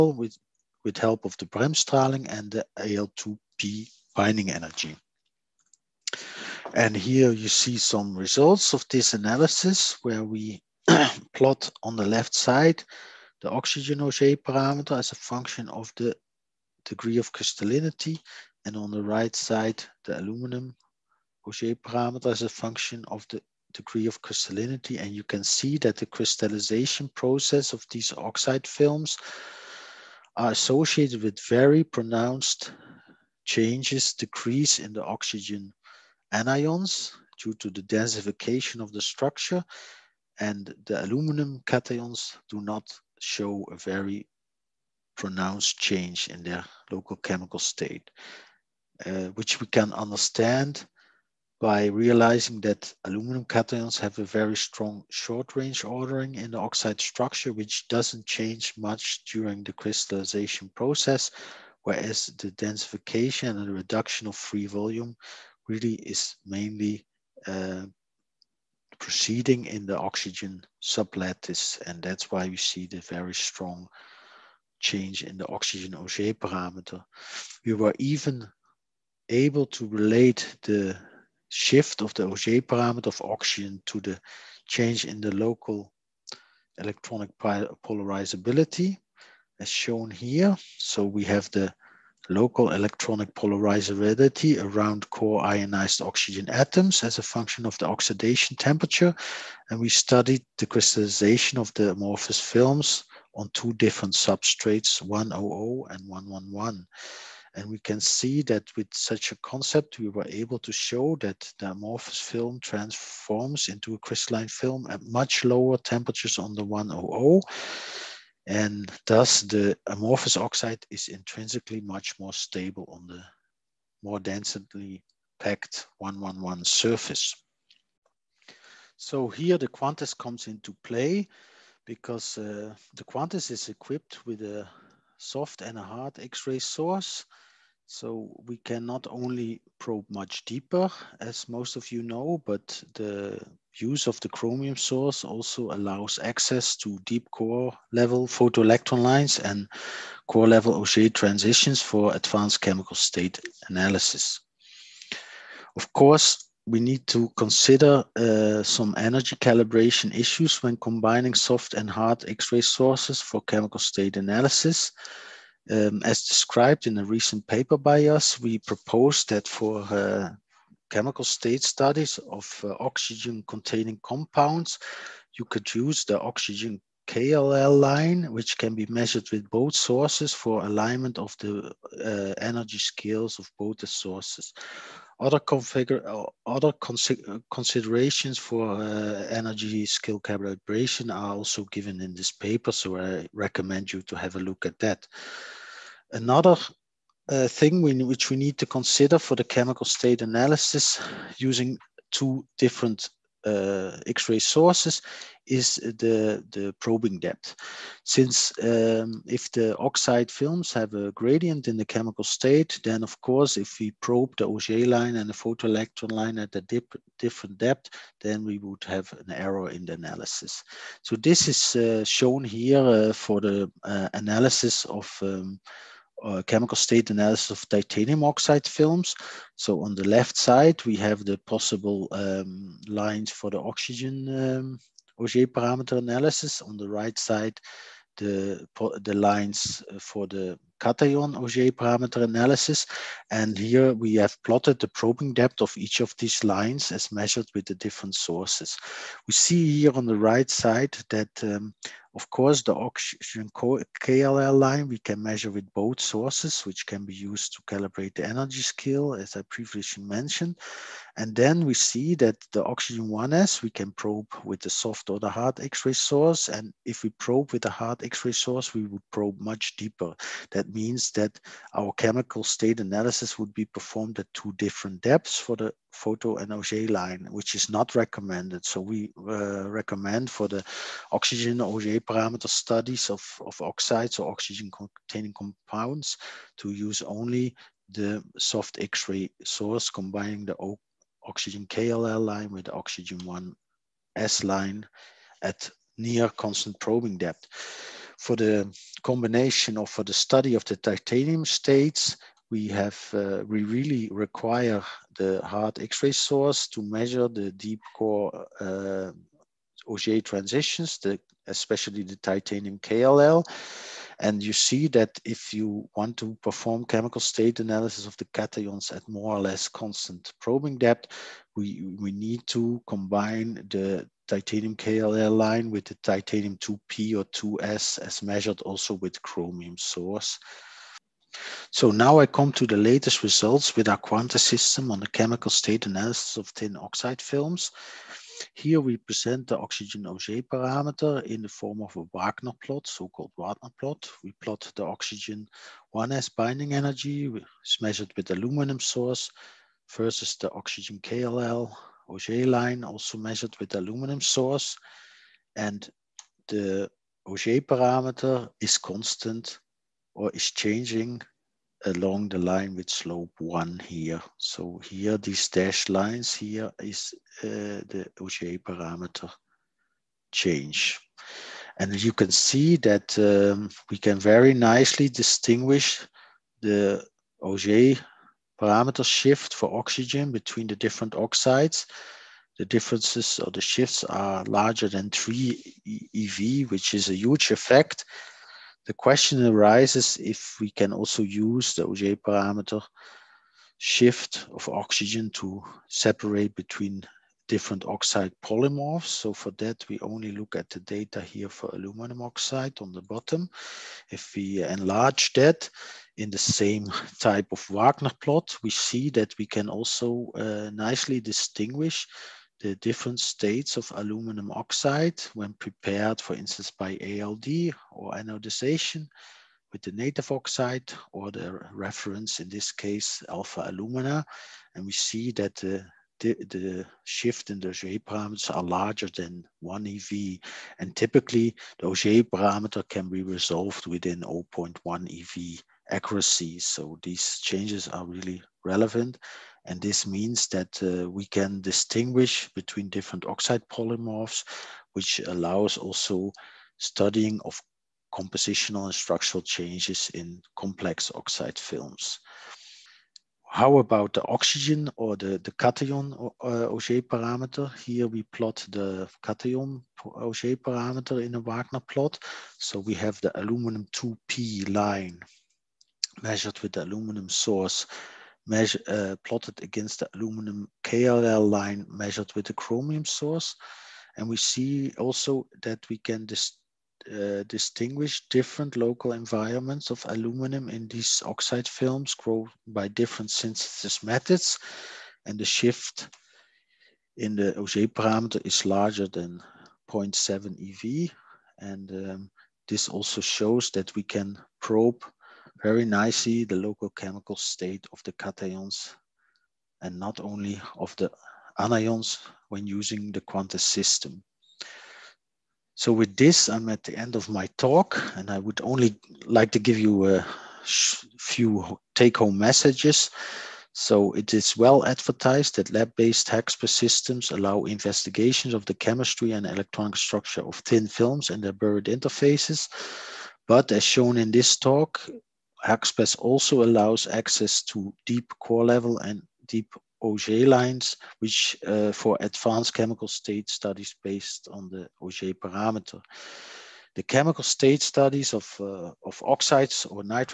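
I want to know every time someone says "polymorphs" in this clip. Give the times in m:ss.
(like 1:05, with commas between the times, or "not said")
6:38, 7:23.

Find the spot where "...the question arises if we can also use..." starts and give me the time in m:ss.
6:28.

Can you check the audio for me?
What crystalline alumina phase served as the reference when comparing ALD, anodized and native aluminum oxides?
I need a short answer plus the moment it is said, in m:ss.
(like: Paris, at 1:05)
Alpha alumina, at 7:03.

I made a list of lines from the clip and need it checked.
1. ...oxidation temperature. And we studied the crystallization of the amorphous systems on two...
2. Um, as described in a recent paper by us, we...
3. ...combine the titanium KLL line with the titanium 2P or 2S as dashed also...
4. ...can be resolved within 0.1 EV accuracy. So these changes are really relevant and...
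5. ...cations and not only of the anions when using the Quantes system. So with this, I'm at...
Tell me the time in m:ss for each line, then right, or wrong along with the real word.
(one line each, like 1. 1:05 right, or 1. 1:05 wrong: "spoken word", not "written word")
1. 1:37 wrong: "films", not "systems"
2. 2:45 right
3. 5:22 wrong: "measured", not "dashed"
4. 7:12 right
5. 8:18 right.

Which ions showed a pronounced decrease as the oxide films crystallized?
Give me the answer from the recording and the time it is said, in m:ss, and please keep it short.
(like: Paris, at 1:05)
Oxygen anions, at 0:35.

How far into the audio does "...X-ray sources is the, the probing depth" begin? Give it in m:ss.
3:24.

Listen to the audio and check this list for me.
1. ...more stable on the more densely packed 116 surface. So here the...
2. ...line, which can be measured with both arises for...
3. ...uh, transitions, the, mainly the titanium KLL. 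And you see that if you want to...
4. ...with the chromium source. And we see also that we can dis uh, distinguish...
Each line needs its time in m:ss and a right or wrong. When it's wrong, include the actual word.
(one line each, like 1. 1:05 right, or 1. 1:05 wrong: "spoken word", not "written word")
1. 2:02 wrong: "111", not "116"
2. 2:57 wrong: "sources", not "arises"
3. 5:08 wrong: "especially", not "mainly"
4. 7:52 right.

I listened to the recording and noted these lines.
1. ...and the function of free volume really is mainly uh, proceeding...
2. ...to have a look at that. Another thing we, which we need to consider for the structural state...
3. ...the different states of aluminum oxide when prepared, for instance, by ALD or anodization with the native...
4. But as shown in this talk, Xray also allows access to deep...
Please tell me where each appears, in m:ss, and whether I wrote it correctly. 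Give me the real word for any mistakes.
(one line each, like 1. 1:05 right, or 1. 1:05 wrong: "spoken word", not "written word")
1. 1:03 wrong: "reduction", not "function"
2. 3:14 wrong: "chemical", not "structural"
3. 6:52 right
4. 8:43 wrong: "HAXPES", not "Xray".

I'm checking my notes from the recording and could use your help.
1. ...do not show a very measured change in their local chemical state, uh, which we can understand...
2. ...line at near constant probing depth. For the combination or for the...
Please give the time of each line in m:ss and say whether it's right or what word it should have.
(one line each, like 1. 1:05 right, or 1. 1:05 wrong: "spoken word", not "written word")
1. 0:42 wrong: "pronounced", not "measured"
2. 4:54 right.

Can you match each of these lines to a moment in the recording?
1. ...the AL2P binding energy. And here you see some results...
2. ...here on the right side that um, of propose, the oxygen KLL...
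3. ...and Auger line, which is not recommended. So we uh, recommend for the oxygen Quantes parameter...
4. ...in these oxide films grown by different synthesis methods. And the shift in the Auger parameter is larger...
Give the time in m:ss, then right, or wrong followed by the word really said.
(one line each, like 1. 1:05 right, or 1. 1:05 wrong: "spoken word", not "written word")
1. 0:02 right
2. 4:09 wrong: "course", not "propose"
3. 4:36 wrong: "Auger", not "Quantes"
4. 8:00 right.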